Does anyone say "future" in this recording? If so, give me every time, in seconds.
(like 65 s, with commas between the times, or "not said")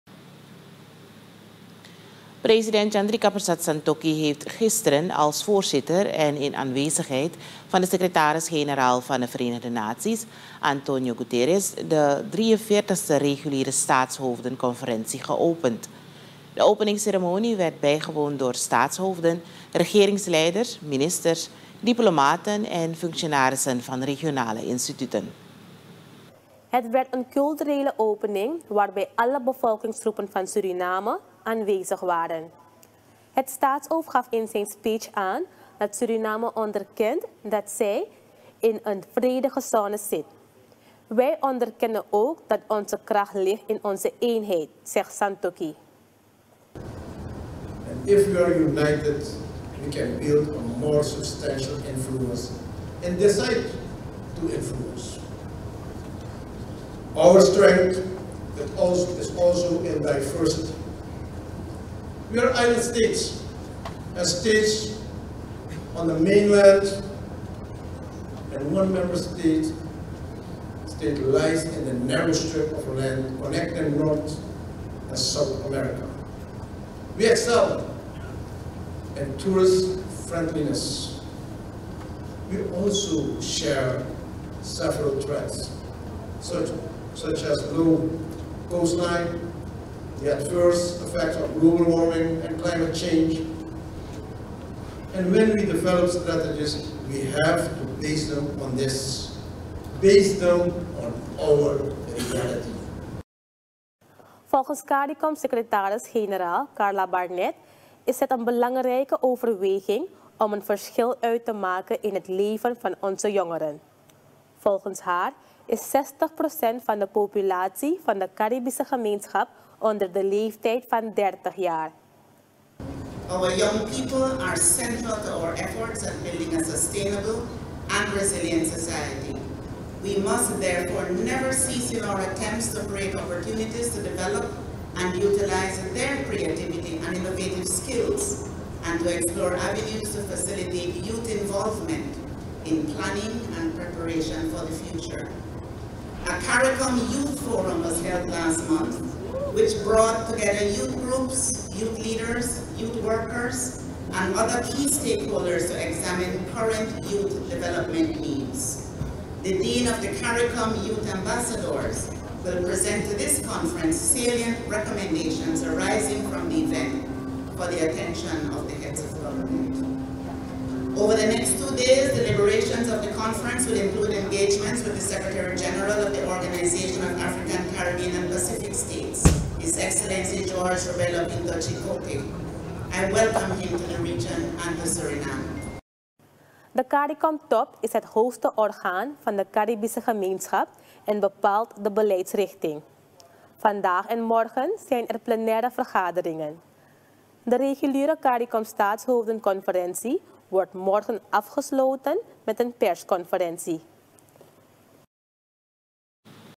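144 s.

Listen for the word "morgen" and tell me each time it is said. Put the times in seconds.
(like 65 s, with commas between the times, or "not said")
194 s, 200 s.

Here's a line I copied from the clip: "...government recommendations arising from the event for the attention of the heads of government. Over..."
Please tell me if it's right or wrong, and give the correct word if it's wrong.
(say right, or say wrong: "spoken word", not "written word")
wrong: "salient", not "government".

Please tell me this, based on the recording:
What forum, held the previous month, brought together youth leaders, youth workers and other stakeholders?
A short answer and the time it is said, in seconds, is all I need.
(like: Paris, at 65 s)
CARICOM Youth Forum, at 146 s.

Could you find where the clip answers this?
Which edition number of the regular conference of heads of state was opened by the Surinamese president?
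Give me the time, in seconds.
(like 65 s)
12 s.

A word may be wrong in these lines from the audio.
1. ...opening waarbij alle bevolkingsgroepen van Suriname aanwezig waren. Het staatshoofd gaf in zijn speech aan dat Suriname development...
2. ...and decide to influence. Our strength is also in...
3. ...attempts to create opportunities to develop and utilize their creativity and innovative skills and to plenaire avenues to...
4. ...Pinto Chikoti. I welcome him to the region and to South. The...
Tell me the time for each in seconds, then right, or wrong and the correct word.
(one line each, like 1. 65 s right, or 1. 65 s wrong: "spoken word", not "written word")
1. 27 s wrong: "onderkent", not "development"
2. 53 s right
3. 132 s wrong: "explore", not "plenaire"
4. 181 s wrong: "Suriname", not "South".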